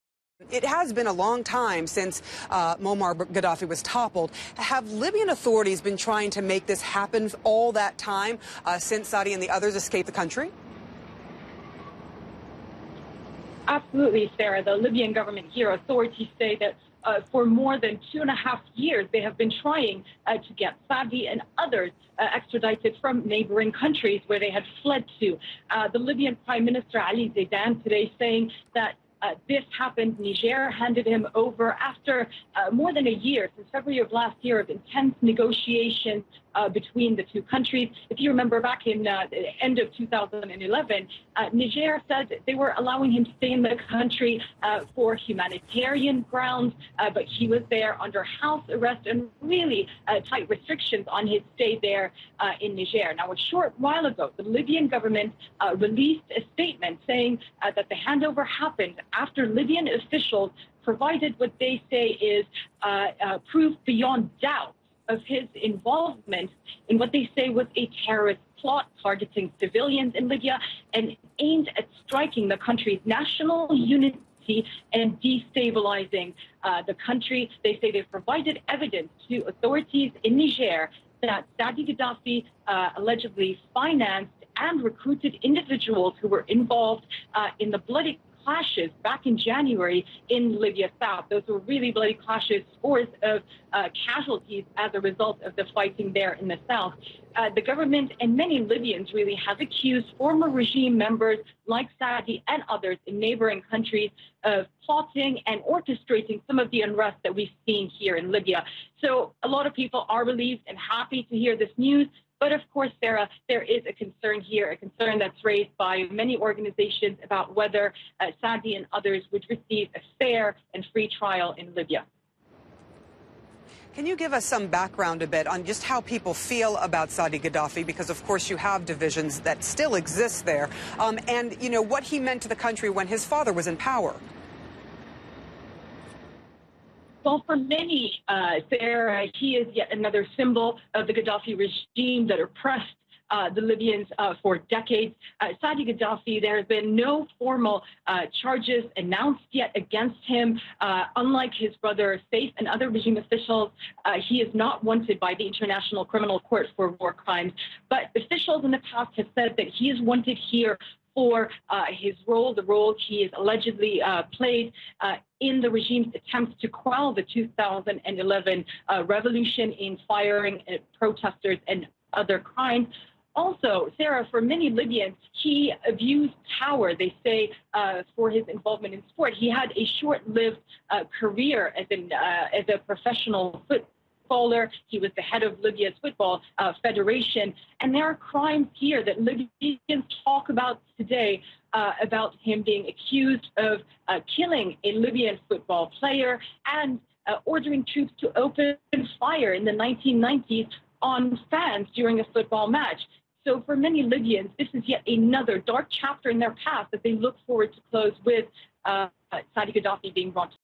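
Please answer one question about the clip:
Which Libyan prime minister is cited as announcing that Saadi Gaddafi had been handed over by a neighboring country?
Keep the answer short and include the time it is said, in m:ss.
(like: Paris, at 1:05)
Ali Zaidan, at 0:27.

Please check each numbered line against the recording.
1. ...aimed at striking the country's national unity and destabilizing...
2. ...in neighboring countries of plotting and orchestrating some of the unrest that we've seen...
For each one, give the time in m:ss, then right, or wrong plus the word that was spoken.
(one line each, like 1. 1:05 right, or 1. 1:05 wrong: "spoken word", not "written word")
1. 1:11 right
2. 1:43 right.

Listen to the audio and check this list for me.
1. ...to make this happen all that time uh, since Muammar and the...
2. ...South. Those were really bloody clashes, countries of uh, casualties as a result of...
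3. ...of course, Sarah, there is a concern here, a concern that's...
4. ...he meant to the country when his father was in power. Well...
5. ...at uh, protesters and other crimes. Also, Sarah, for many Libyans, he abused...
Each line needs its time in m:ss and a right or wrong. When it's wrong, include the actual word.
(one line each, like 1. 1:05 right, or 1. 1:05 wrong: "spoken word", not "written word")
1. 0:06 wrong: "Saadi", not "Muammar"
2. 1:31 wrong: "scores", not "countries"
3. 1:52 right
4. 2:12 right
5. 2:50 right.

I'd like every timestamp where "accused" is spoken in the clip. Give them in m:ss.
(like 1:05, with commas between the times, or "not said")
1:39, 3:12.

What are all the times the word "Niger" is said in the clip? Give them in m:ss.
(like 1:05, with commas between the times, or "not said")
0:30, 0:41, 0:52, 1:20.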